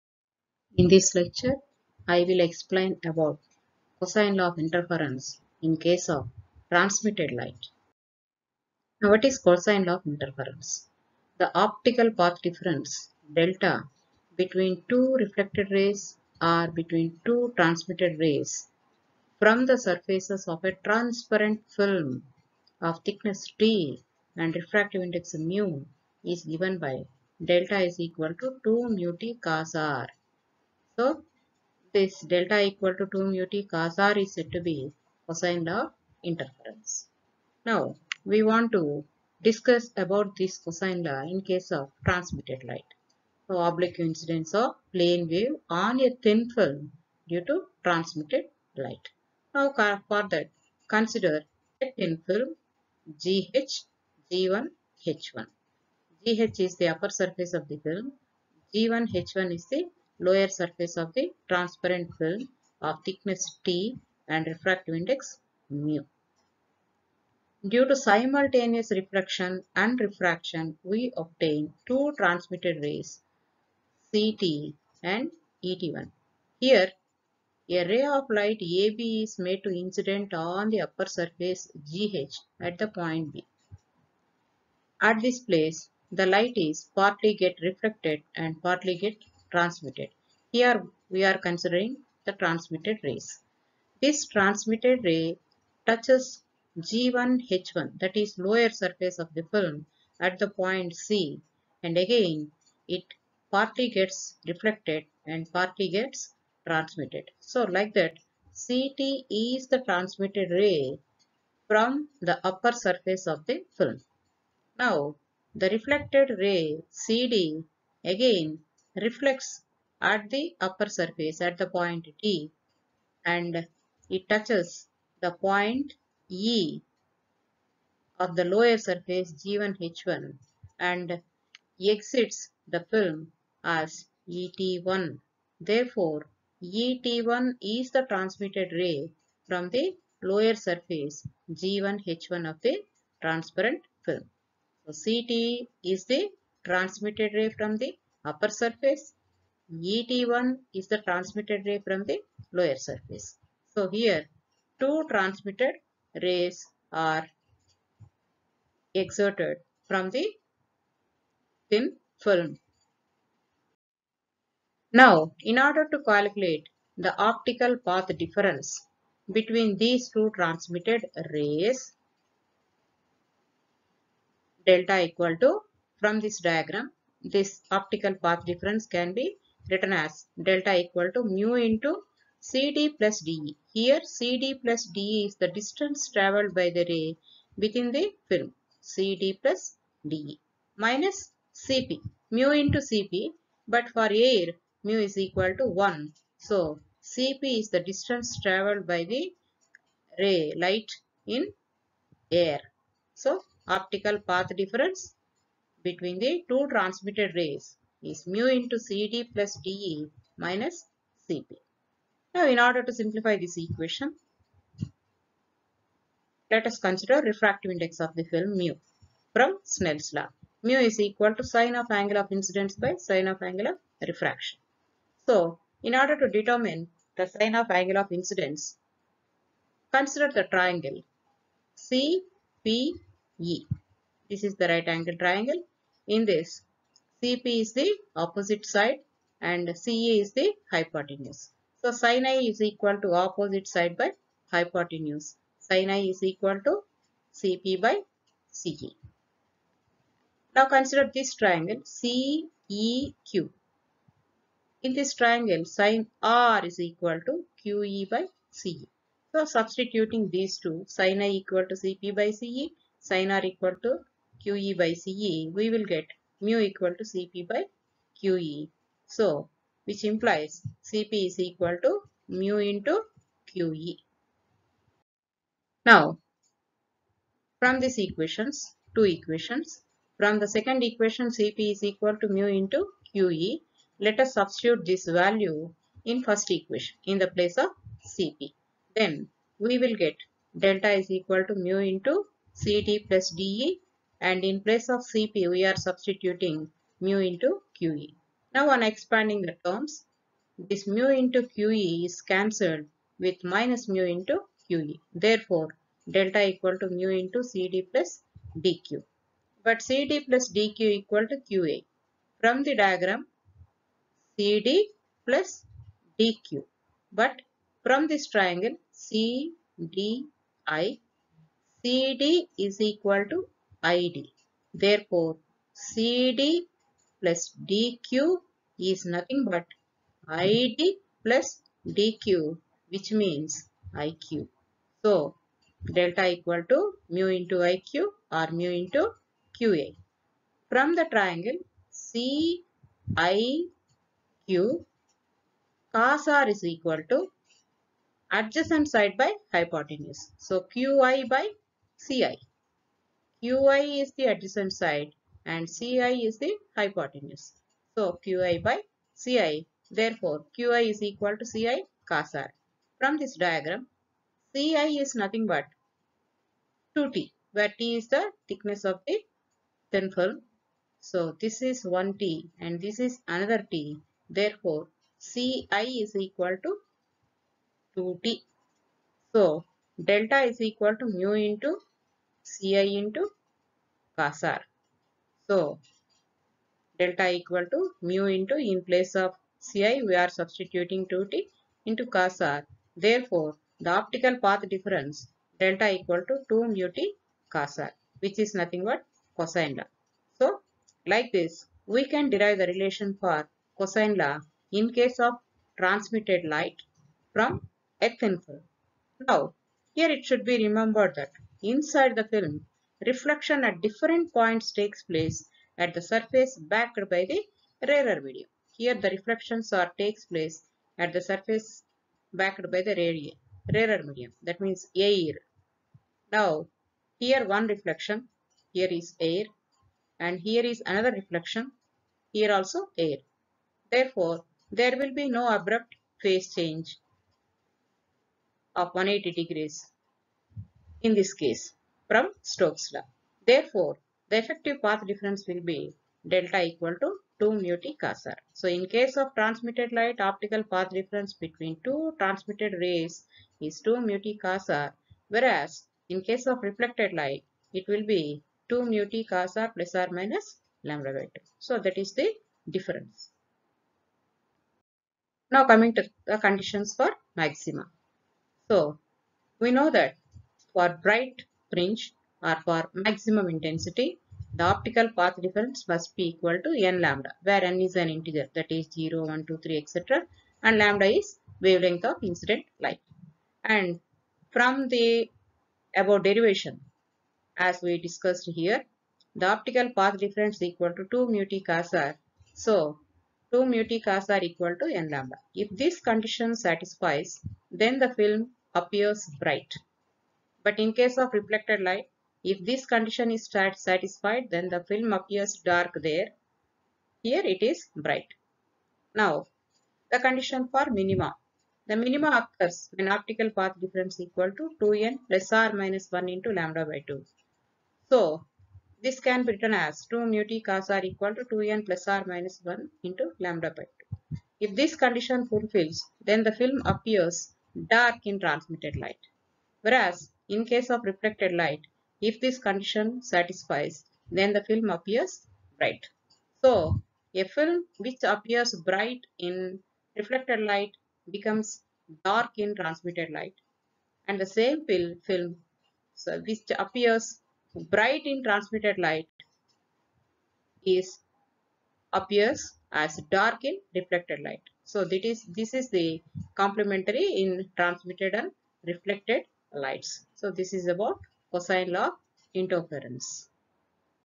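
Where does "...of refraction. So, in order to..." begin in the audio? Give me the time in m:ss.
3:43.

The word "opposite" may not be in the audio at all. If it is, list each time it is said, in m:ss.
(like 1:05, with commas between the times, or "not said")
3:58, 4:03.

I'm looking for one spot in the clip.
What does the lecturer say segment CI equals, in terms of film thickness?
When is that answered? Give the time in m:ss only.
6:15.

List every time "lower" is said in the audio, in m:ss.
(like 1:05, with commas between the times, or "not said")
1:00, 1:38, 2:08, 2:20, 2:32.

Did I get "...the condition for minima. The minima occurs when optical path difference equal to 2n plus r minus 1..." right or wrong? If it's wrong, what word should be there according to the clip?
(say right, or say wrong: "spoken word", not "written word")
right.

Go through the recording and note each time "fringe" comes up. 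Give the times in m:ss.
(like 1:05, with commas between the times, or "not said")
7:51.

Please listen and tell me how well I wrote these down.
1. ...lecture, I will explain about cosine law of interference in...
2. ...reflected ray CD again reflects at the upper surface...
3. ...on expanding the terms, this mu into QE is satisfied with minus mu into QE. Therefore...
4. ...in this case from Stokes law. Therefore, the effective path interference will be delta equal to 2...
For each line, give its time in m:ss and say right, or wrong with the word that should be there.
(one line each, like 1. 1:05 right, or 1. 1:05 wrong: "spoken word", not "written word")
1. 0:01 right
2. 1:55 right
3. 4:58 wrong: "cancelled", not "satisfied"
4. 7:21 wrong: "difference", not "interference".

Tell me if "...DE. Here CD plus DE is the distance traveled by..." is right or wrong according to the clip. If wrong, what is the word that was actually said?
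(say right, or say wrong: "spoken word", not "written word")
right.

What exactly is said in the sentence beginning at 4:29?
So, which implies CP is equal to mu into QE.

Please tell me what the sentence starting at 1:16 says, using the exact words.
Here, a ray of light AB is made to incident on the upper surface GH at the point B.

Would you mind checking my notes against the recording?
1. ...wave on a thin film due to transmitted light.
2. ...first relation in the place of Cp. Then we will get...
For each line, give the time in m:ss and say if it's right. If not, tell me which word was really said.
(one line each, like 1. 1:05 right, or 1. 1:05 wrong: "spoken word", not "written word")
1. 0:45 right
2. 4:46 wrong: "equation", not "relation".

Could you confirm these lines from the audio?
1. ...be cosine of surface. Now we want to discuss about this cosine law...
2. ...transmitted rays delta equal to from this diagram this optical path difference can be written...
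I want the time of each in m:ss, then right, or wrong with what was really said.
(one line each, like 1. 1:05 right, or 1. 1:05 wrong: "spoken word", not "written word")
1. 0:34 wrong: "interference", not "surface"
2. 2:50 right.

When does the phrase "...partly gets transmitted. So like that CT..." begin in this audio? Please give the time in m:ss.
1:45.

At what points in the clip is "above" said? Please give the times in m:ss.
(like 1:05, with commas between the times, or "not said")
8:05.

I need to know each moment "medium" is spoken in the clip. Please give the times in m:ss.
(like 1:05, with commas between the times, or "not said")
6:58, 7:04.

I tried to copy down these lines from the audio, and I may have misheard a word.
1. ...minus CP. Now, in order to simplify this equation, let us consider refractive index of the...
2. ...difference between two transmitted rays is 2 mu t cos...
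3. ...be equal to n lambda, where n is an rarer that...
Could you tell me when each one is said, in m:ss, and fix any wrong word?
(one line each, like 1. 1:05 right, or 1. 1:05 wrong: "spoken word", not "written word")
1. 3:30 right
2. 7:30 right
3. 7:56 wrong: "integer", not "rarer".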